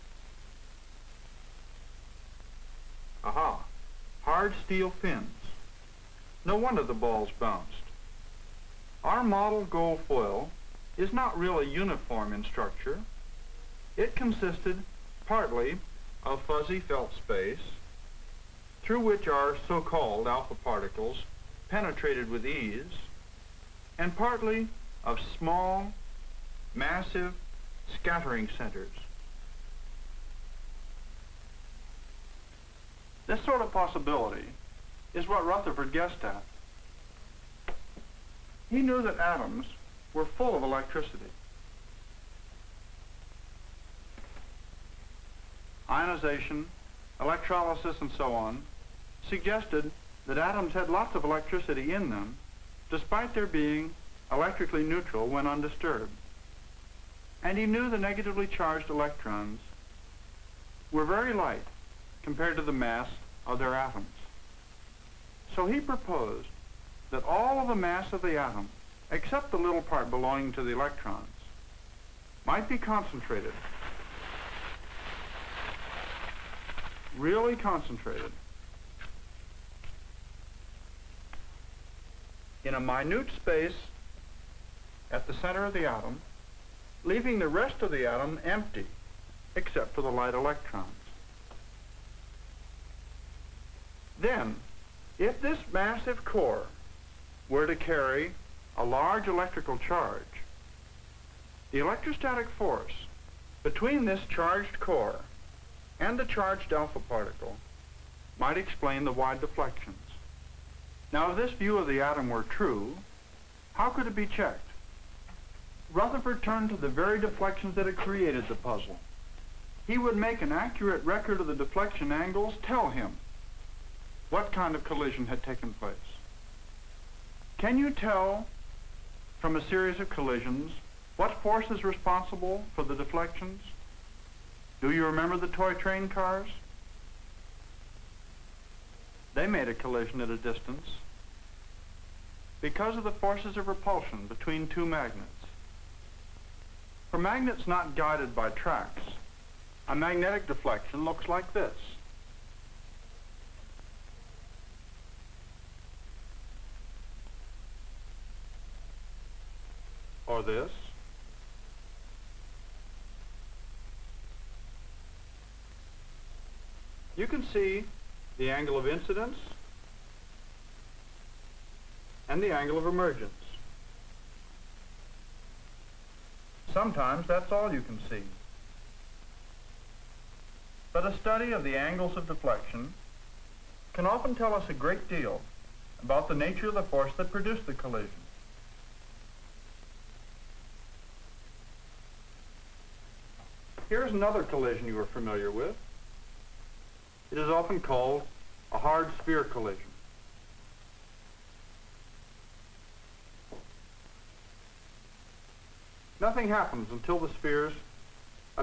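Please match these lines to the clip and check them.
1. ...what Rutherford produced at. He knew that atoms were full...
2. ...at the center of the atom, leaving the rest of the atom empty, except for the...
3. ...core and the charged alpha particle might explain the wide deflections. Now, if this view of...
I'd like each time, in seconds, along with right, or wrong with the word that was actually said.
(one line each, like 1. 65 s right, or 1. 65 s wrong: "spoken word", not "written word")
1. 35 s wrong: "guessed", not "produced"
2. 85 s right
3. 104 s right.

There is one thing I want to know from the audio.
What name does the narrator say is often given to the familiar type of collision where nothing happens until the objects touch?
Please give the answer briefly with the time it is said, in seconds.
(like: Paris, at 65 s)
hard sphere collision, at 198 s.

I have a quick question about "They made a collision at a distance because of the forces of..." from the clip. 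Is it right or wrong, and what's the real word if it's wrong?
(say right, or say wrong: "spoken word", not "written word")
right.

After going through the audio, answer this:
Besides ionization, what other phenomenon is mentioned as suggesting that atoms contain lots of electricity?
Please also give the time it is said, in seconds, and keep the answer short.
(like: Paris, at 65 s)
electrolysis, at 47 s.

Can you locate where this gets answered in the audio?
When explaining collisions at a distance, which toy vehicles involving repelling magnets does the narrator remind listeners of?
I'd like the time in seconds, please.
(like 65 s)
135 s.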